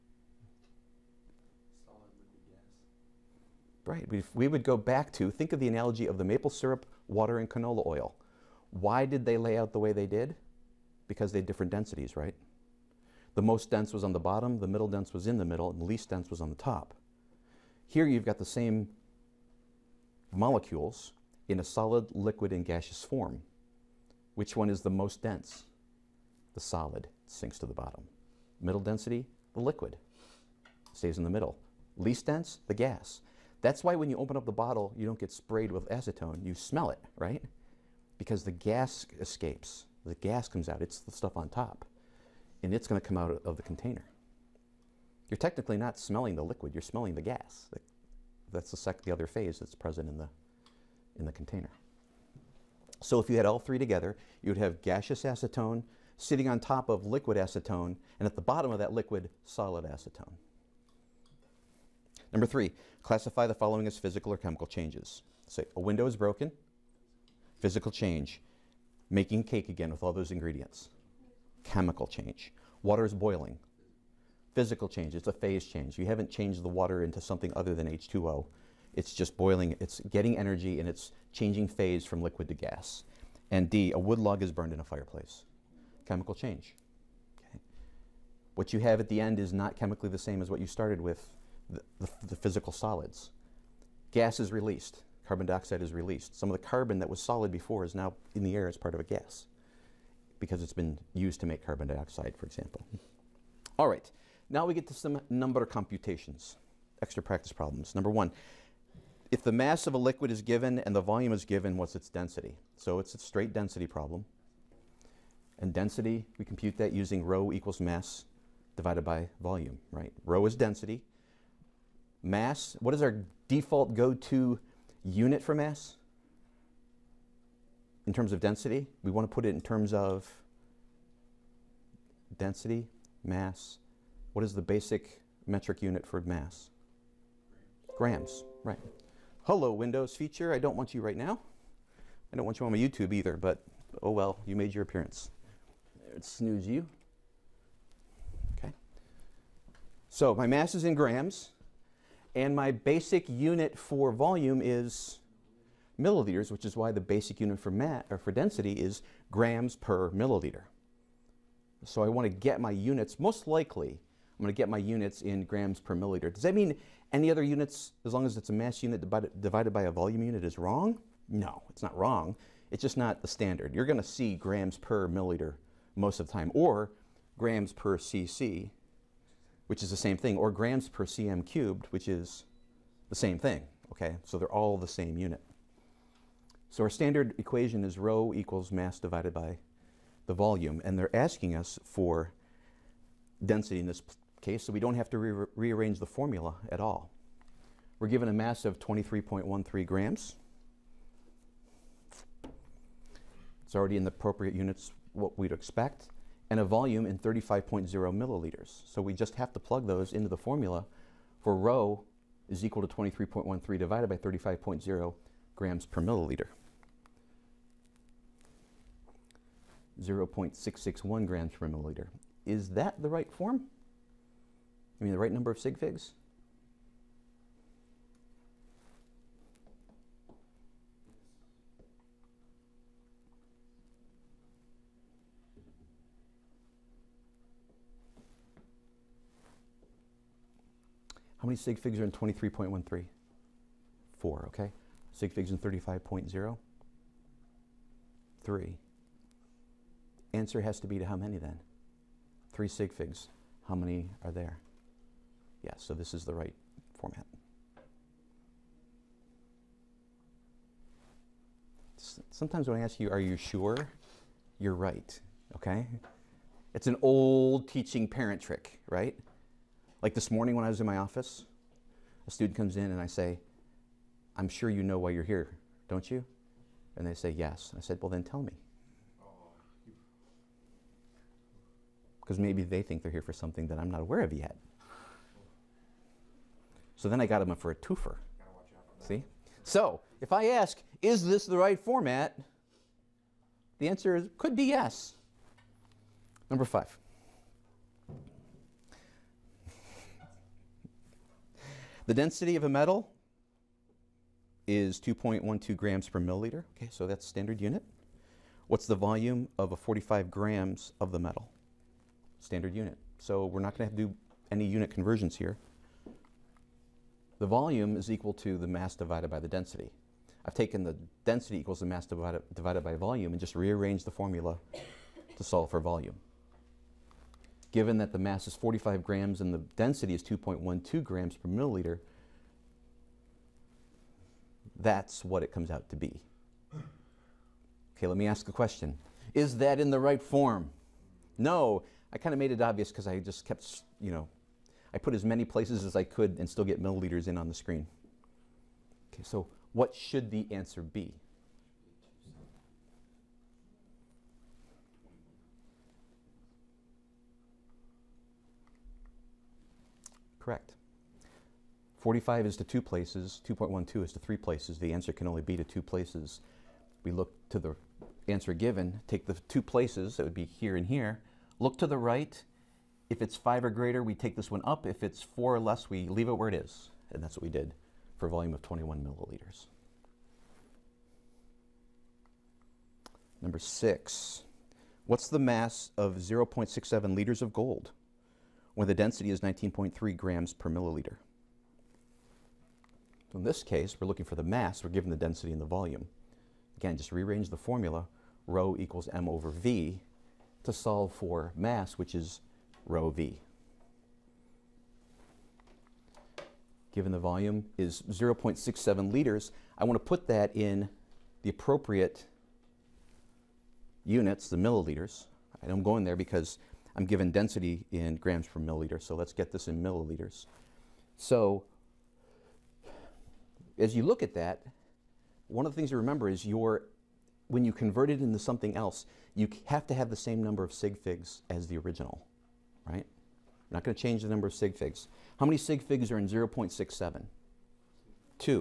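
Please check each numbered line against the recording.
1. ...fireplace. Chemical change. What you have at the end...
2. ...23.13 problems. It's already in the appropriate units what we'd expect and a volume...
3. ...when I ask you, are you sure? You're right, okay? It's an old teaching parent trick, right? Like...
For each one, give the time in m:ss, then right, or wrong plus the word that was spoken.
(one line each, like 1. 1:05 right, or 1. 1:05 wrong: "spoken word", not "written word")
1. 1:24 right
2. 3:18 wrong: "grams", not "problems"
3. 4:22 right.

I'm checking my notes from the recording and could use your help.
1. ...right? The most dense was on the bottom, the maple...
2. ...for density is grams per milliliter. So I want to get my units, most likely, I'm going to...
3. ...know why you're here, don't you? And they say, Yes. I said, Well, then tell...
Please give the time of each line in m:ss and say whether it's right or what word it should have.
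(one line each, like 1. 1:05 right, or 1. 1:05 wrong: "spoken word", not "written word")
1. 0:12 wrong: "middle", not "maple"
2. 2:38 right
3. 4:34 right.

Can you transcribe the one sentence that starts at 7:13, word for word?
i are not going to change the number of sig figs.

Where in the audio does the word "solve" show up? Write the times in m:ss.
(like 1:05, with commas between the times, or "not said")
5:25, 6:40.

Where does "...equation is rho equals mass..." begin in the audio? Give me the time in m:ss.
3:07.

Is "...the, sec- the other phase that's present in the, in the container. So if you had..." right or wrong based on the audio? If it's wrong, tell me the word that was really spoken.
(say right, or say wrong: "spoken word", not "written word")
right.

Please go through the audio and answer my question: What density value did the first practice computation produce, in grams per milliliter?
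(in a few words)
0.661.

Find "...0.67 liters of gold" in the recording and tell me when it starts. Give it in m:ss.
6:26.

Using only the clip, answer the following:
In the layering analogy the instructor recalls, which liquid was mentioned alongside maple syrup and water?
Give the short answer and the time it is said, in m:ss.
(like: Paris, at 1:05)
canola oil, at 0:07.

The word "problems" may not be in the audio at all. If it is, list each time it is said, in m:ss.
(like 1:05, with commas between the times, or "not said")
1:47, 1:53.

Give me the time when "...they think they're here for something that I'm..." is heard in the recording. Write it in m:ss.
4:42.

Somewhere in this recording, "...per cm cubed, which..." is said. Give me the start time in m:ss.
3:00.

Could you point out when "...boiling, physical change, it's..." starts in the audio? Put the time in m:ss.
1:13.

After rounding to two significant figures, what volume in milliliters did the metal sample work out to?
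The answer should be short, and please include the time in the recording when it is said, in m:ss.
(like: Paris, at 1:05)
21 milliliters, at 6:18.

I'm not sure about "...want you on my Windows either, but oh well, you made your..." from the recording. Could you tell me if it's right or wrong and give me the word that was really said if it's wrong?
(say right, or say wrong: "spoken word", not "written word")
wrong: "YouTube", not "Windows".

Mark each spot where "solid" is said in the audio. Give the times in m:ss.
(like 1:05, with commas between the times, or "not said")
0:21, 0:26, 0:59, 1:32, 1:37.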